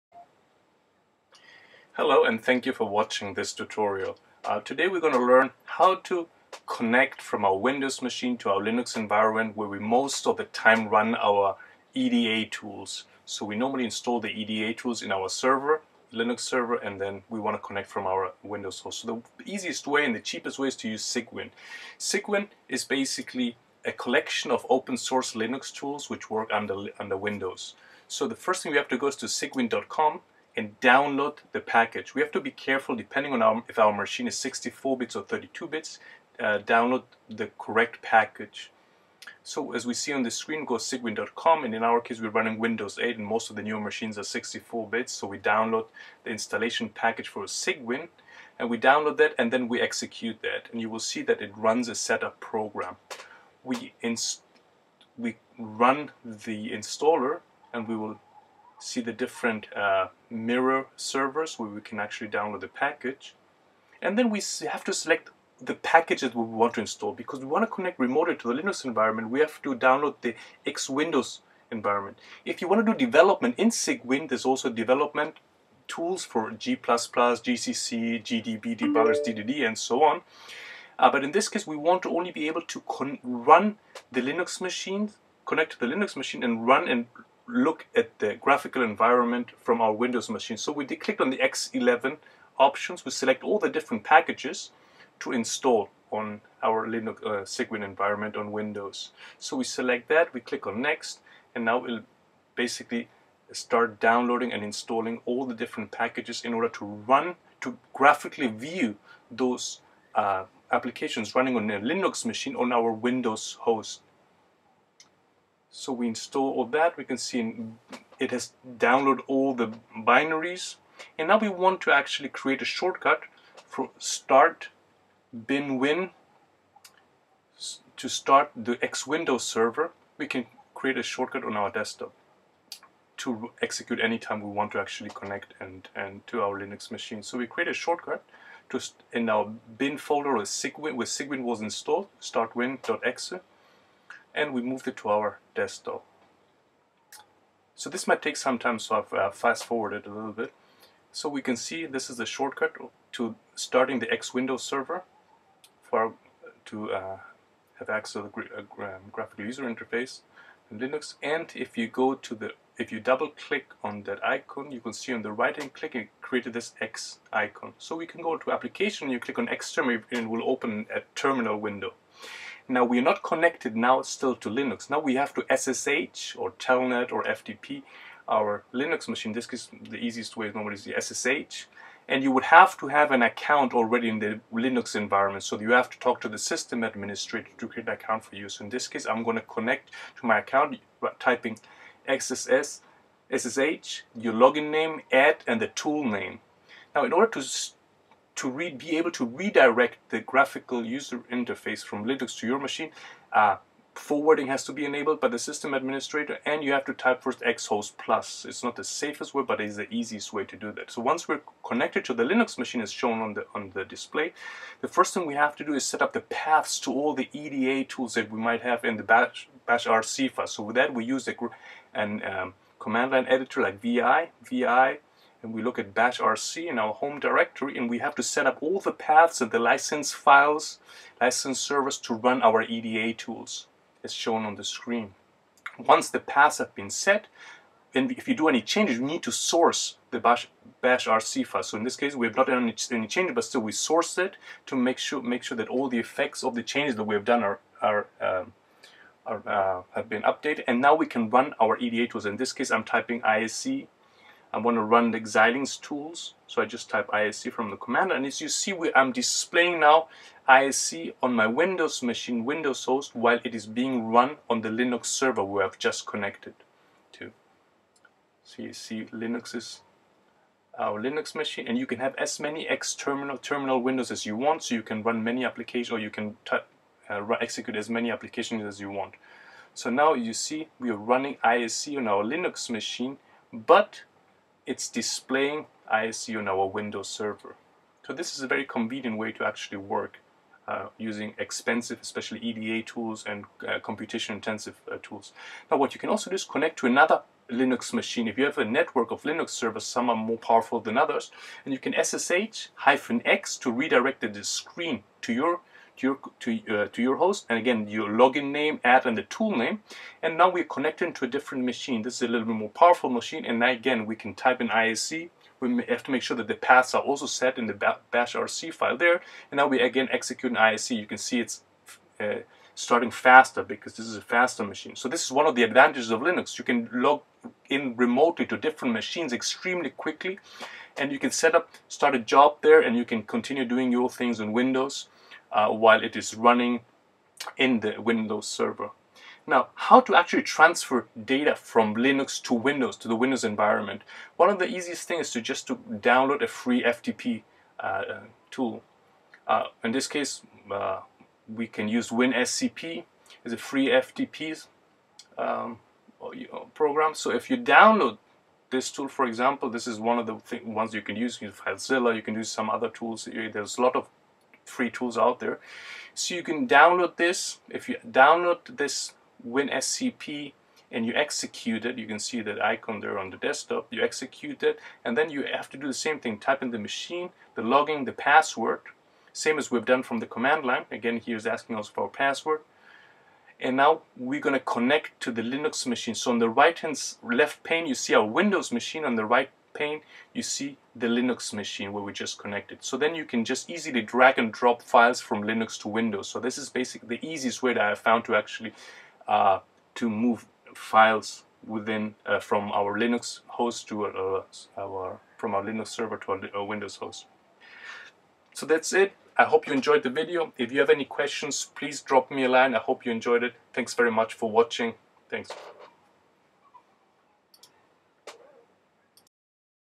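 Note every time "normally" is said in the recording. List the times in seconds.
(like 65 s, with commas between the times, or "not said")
13 s, 180 s.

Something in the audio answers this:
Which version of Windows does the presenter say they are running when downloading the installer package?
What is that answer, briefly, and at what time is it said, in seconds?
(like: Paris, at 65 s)
Windows 8, at 42 s.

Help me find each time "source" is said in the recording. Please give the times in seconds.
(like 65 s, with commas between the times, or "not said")
24 s, 239 s, 243 s.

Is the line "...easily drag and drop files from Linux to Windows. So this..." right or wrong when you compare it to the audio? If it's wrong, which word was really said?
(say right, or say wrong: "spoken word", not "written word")
right.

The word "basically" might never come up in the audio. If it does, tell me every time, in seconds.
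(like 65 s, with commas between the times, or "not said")
22 s, 102 s, 396 s.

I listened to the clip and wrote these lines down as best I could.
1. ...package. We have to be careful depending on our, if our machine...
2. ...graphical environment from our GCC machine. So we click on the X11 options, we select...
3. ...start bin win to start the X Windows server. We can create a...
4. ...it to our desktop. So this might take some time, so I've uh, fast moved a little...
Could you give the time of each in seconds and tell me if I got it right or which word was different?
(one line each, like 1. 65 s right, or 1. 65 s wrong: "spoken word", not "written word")
1. 31 s right
2. 88 s wrong: "Windows", not "GCC"
3. 123 s right
4. 144 s wrong: "forwarded", not "moved".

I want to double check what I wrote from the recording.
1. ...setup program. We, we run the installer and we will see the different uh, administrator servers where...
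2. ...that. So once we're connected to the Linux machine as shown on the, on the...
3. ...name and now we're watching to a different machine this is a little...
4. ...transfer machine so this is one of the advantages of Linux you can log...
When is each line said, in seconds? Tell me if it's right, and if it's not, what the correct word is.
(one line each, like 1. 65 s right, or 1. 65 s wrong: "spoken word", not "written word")
1. 51 s wrong: "mirror", not "administrator"
2. 210 s right
3. 309 s wrong: "connecting", not "watching"
4. 324 s wrong: "faster", not "transfer".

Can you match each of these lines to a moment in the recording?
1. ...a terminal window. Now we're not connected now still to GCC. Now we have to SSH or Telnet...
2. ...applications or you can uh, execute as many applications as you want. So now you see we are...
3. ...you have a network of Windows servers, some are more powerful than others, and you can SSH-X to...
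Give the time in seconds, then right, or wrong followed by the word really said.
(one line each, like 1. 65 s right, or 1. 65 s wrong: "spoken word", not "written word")
1. 170 s wrong: "Linux", not "GCC"
2. 275 s right
3. 298 s wrong: "Linux", not "Windows".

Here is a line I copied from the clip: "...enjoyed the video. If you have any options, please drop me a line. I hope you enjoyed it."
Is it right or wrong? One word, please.
wrong.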